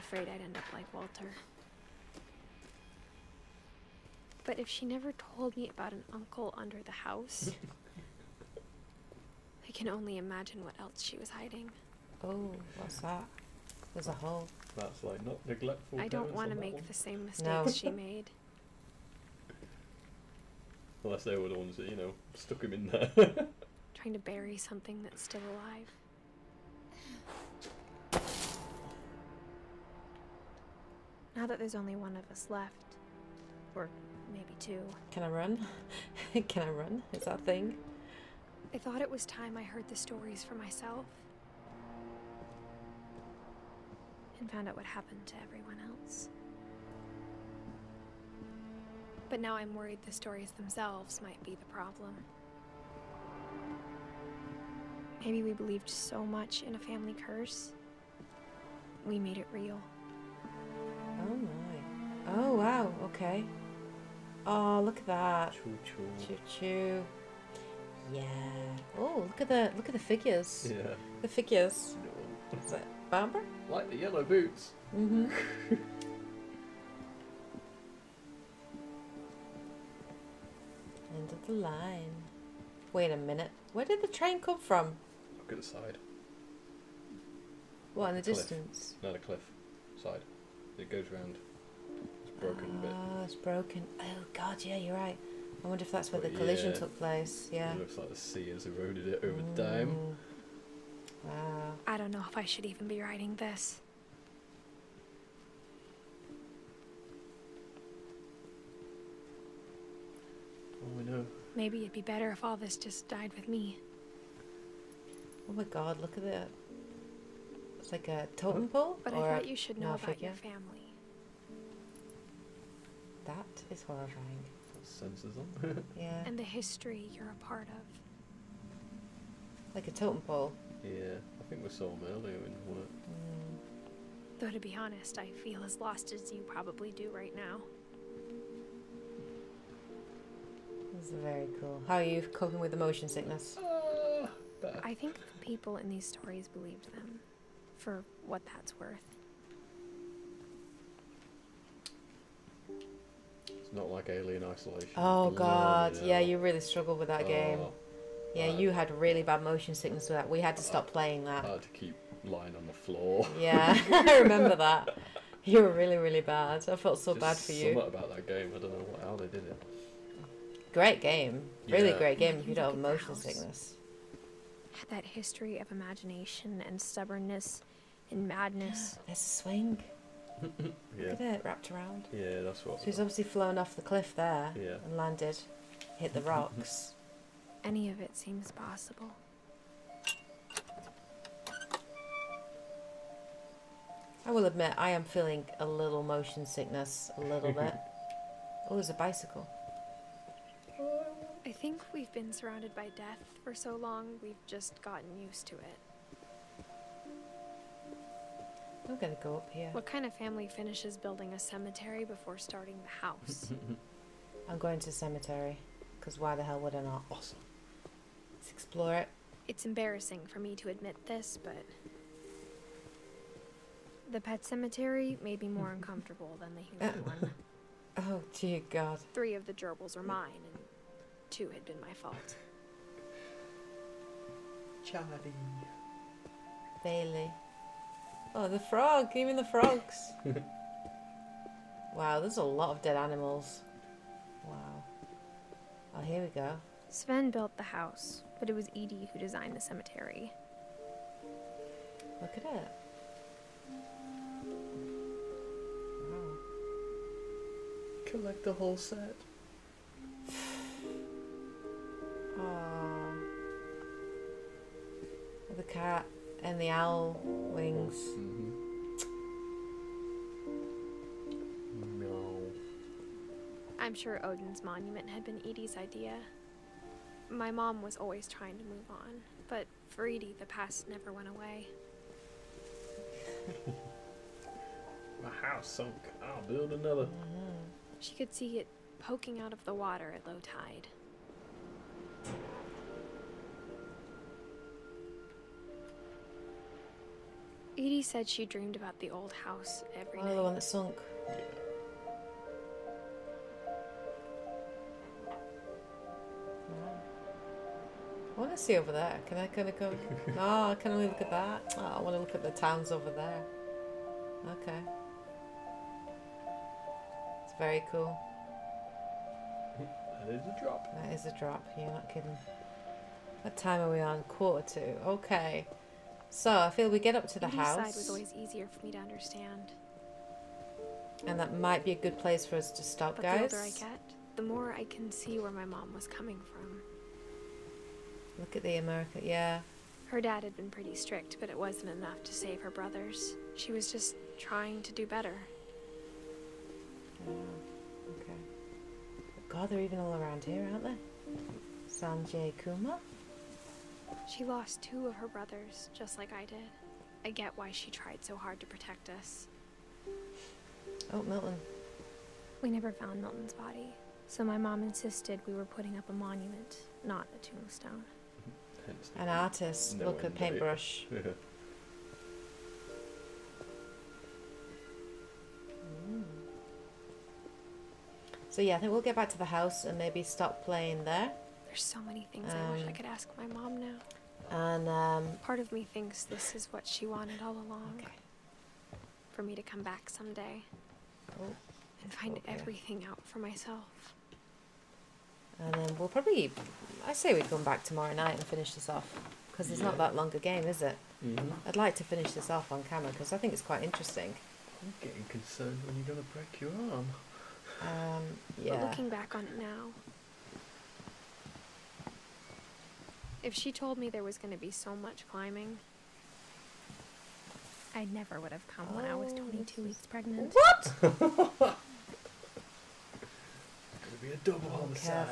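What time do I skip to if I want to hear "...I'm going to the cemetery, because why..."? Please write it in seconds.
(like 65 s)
214 s.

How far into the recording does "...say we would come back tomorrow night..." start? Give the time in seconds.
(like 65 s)
397 s.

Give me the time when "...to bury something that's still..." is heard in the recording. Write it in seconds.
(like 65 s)
24 s.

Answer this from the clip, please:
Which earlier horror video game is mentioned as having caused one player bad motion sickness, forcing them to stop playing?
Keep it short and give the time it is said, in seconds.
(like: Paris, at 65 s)
Alien Isolation, at 154 s.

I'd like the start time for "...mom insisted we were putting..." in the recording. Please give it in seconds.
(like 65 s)
364 s.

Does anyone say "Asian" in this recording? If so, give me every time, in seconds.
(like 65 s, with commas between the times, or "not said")
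not said.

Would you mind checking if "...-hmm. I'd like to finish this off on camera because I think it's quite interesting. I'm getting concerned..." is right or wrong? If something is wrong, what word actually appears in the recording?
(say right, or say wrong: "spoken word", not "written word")
right.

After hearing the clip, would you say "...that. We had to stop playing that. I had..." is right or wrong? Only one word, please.
right.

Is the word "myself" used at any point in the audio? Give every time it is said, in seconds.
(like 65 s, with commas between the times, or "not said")
40 s, 393 s.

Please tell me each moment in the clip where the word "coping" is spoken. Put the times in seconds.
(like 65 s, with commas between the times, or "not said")
142 s.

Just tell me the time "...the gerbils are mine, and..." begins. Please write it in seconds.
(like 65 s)
229 s.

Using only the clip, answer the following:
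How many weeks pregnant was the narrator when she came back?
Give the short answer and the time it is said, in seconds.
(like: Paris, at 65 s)
22, at 419 s.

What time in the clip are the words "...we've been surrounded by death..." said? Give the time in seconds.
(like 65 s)
201 s.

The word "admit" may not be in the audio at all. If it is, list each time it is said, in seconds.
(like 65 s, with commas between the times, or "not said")
194 s, 220 s.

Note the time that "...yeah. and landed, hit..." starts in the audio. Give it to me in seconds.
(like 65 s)
184 s.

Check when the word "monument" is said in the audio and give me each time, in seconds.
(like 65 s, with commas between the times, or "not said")
274 s, 366 s.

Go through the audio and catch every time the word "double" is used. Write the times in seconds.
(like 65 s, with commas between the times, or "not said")
424 s.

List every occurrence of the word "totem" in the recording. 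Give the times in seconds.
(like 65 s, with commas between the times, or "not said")
118 s, 129 s.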